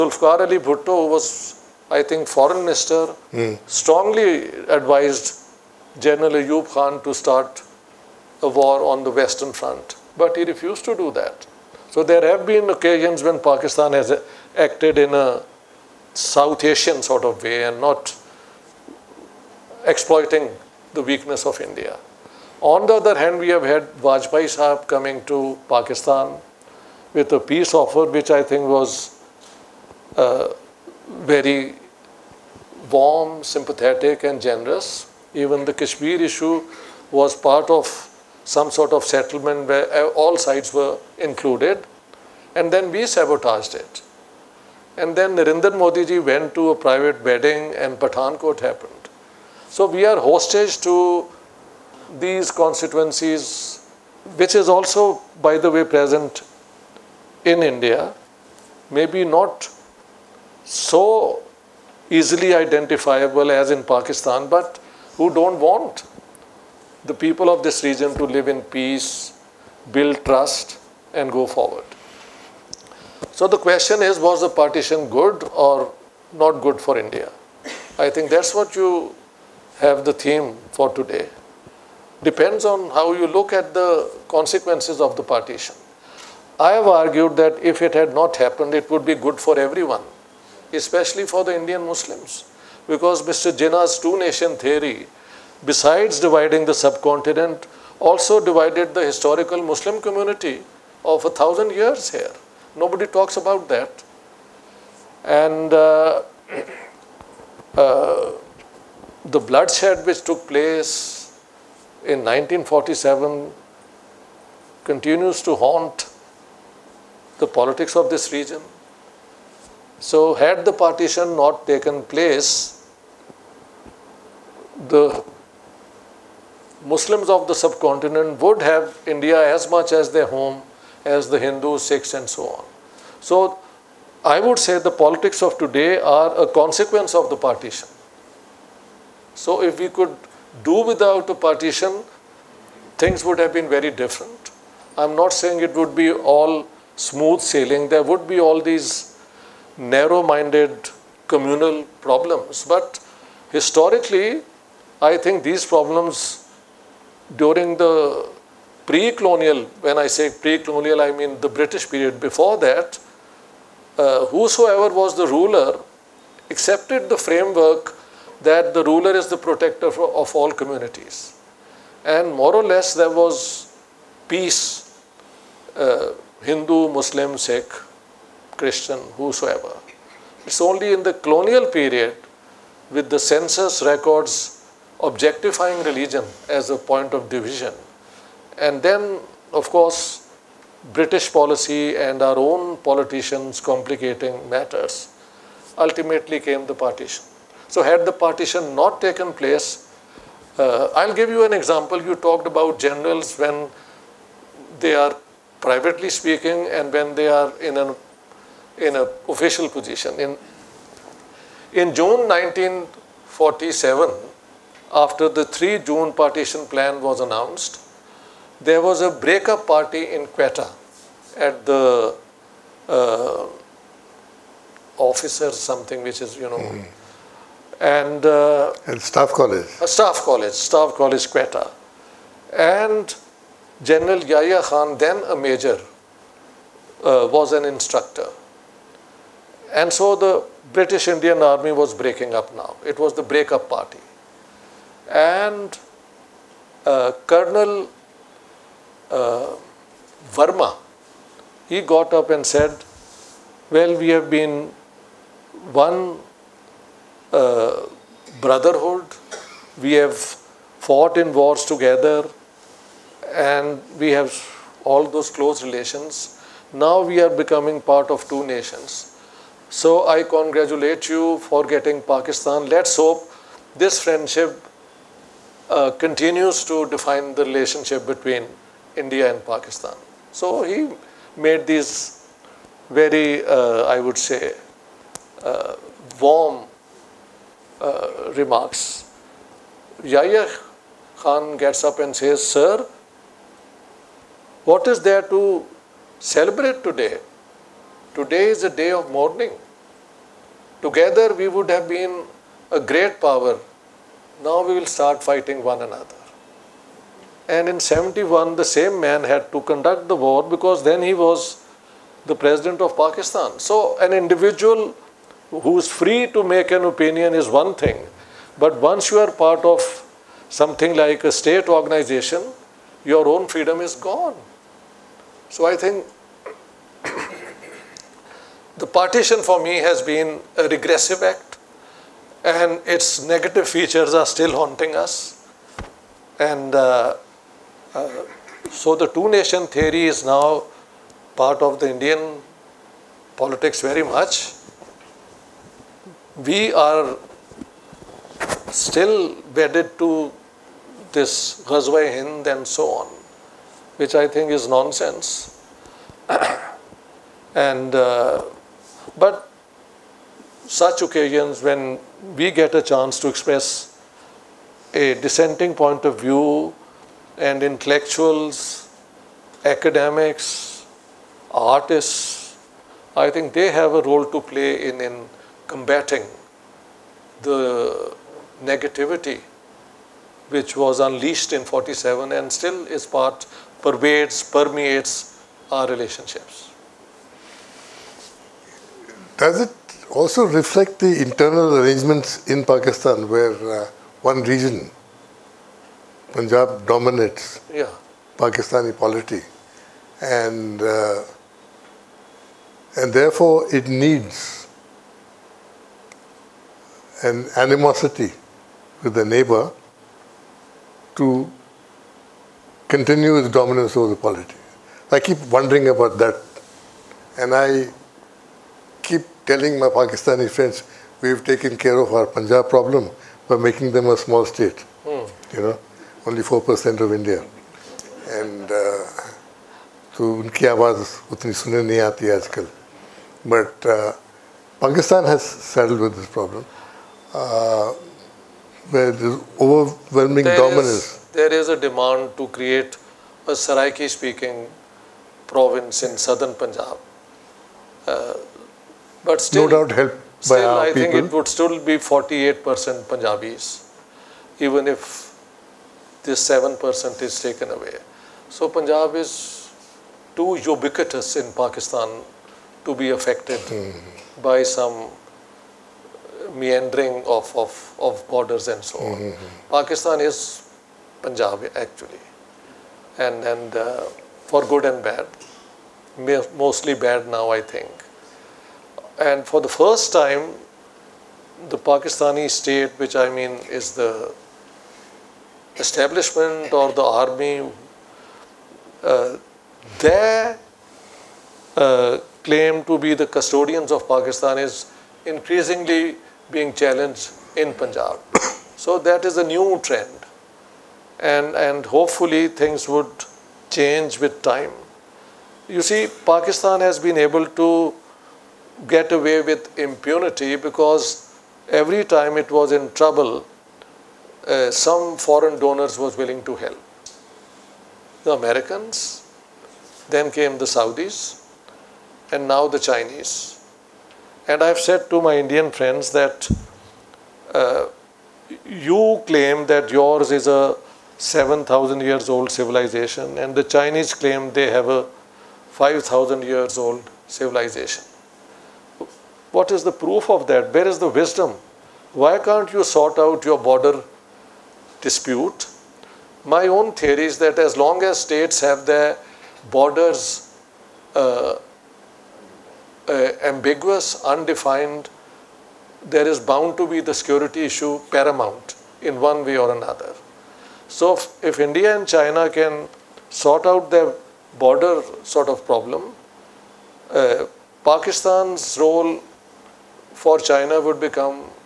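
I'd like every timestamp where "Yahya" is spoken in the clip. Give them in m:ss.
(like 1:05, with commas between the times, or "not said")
3:54, 4:50.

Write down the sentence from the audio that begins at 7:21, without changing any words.
Is, there is a demand to create a Saraiki speaking province in southern Punjab.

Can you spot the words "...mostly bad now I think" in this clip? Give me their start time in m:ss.
7:56.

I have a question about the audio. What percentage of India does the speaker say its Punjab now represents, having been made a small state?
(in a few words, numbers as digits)
4%.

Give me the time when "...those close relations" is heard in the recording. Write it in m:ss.
4:25.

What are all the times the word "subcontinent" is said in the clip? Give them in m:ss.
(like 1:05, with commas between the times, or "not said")
1:36, 2:07.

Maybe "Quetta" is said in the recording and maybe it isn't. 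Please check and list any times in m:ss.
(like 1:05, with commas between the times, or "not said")
3:40, 3:51.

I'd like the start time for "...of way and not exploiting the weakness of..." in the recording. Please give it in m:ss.
0:17.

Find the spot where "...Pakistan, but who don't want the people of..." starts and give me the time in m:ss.
1:03.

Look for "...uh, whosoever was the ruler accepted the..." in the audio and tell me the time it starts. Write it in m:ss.
2:43.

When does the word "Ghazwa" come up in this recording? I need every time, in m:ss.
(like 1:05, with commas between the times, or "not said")
5:51.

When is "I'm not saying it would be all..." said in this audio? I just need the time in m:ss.
2:24.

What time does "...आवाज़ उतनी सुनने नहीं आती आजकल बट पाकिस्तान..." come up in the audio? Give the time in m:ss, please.
7:10.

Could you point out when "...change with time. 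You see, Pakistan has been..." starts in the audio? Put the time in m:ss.
8:23.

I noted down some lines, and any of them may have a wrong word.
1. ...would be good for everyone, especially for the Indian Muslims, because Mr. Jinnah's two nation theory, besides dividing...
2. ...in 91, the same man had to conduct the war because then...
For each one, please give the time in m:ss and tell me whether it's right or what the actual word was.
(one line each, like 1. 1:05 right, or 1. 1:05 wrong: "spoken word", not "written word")
1. 1:28 right
2. 5:07 wrong: "71", not "91".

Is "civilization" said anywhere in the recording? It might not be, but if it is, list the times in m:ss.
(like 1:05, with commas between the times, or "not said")
8:52, 8:57.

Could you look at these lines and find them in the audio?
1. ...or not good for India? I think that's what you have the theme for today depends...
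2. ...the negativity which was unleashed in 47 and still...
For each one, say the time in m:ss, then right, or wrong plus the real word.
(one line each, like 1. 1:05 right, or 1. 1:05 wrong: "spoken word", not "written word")
1. 1:15 right
2. 6:17 right.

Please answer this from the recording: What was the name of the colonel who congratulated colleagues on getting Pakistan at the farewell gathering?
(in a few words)
Verma.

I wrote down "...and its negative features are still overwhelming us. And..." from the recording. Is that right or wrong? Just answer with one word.
wrong.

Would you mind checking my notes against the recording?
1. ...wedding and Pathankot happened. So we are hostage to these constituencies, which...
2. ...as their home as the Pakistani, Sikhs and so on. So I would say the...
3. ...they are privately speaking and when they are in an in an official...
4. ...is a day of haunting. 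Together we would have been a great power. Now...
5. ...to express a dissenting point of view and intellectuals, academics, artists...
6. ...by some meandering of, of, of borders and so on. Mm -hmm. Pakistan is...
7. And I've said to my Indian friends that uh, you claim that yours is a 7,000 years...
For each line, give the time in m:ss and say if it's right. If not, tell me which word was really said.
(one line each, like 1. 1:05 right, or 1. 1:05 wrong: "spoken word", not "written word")
1. 0:47 right
2. 2:09 wrong: "Hindus", not "Pakistani"
3. 3:24 right
4. 4:58 wrong: "mourning", not "haunting"
5. 6:03 right
6. 7:44 right
7. 8:44 right.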